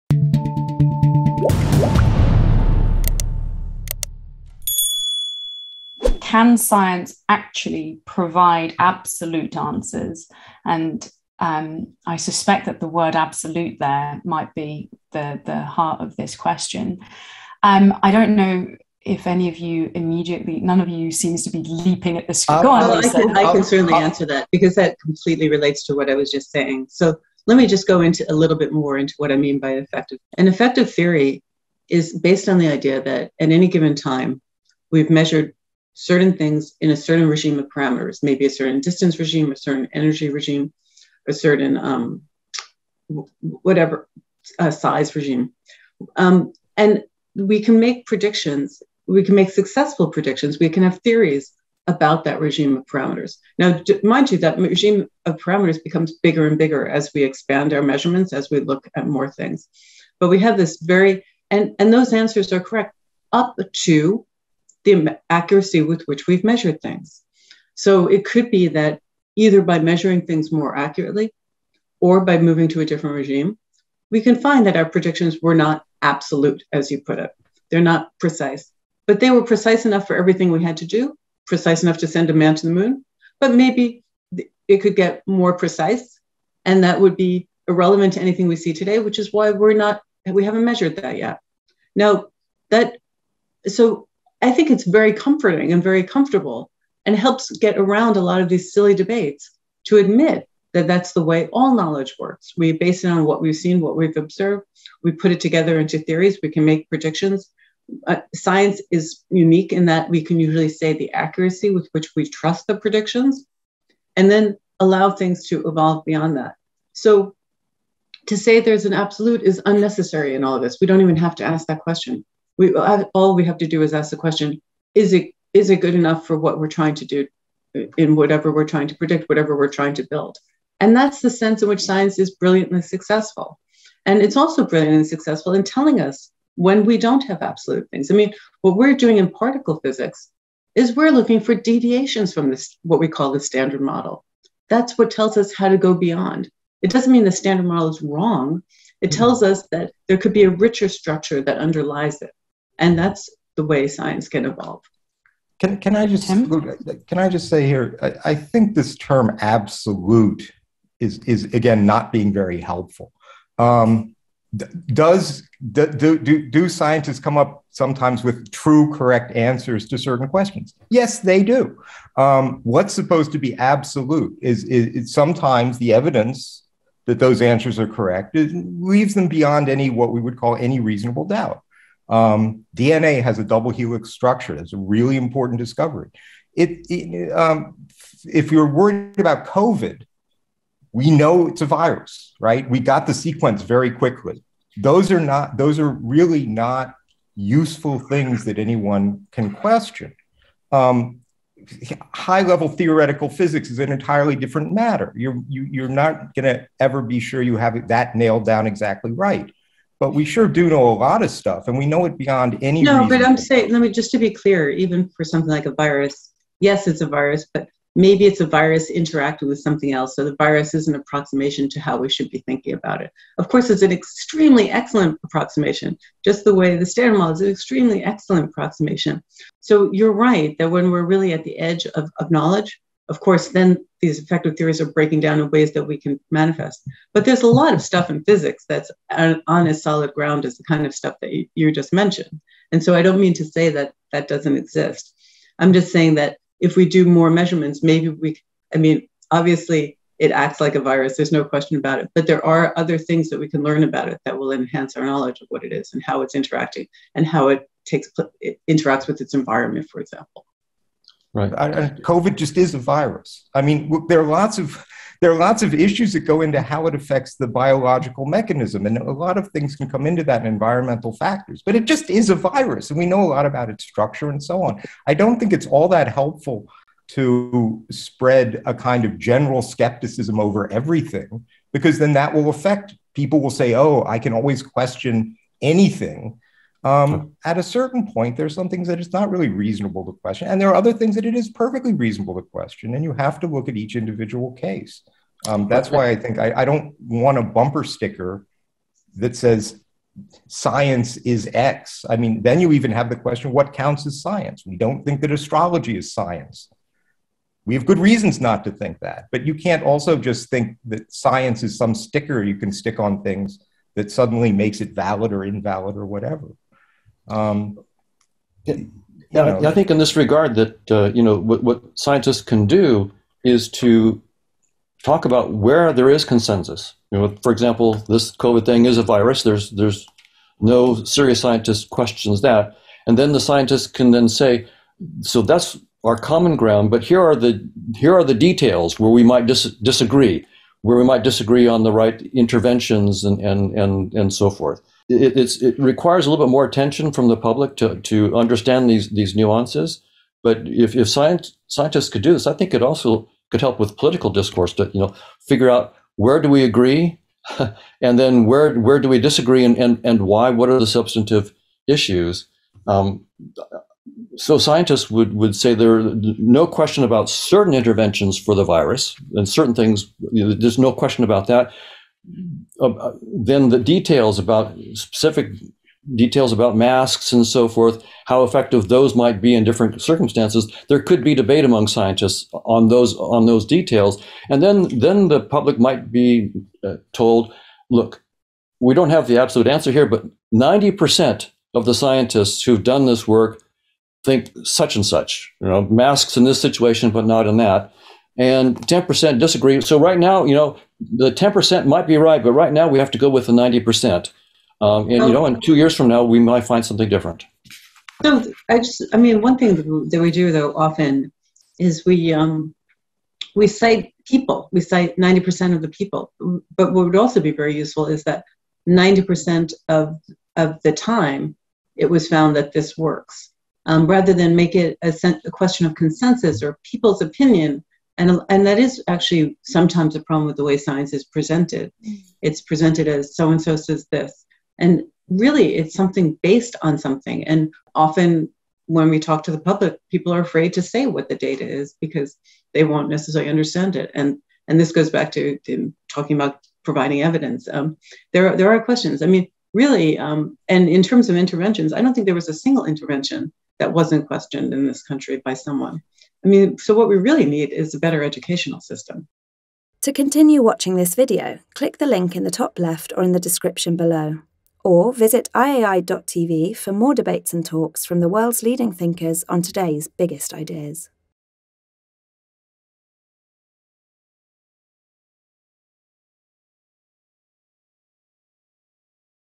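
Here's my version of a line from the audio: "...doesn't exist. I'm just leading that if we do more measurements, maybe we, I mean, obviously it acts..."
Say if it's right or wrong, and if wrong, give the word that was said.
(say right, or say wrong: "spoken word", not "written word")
wrong: "saying", not "leading".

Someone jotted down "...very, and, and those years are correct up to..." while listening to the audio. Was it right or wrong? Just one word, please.
wrong.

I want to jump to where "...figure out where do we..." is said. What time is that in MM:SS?
05:55.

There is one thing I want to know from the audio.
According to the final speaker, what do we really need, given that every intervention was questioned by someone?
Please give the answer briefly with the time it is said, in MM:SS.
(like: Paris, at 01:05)
a better educational system, at 07:37.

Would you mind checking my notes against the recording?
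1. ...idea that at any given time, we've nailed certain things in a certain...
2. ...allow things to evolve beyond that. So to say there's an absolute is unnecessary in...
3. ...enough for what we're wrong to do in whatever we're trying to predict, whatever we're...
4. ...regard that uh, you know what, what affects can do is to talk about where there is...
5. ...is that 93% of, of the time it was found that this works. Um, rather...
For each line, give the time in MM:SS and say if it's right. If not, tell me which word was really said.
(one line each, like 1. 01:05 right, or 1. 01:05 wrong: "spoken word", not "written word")
1. 00:32 wrong: "measured", not "nailed"
2. 01:54 right
3. 02:05 wrong: "trying", not "wrong"
4. 05:20 wrong: "scientists", not "affects"
5. 06:58 wrong: "90", not "93".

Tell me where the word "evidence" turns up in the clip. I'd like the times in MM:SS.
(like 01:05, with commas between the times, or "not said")
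02:55, 07:27.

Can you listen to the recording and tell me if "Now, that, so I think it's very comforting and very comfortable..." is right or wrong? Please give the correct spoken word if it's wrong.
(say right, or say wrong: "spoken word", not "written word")
right.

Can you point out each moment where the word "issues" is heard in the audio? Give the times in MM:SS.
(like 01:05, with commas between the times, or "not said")
04:25, 06:01.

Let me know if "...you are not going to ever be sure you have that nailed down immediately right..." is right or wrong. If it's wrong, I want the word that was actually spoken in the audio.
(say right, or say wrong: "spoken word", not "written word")
wrong: "exactly", not "immediately".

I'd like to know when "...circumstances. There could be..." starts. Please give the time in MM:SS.
06:20.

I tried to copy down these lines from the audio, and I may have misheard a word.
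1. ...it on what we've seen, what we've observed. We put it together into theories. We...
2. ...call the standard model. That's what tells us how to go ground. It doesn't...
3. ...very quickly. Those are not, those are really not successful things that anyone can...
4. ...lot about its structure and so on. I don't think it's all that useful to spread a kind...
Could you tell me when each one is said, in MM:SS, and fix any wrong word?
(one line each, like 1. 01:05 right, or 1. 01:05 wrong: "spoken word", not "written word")
1. 01:43 right
2. 02:23 wrong: "beyond", not "ground"
3. 03:13 wrong: "useful", not "successful"
4. 04:33 wrong: "helpful", not "useful".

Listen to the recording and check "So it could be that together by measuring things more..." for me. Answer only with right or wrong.
wrong.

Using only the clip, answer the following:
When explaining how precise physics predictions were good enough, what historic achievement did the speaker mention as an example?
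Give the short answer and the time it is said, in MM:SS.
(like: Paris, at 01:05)
send a man to the moon, at 01:22.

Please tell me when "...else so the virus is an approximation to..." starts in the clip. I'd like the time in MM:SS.
03:39.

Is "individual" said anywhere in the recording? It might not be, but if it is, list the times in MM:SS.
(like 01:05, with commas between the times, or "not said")
04:53.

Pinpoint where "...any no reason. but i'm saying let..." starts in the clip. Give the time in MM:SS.
03:32.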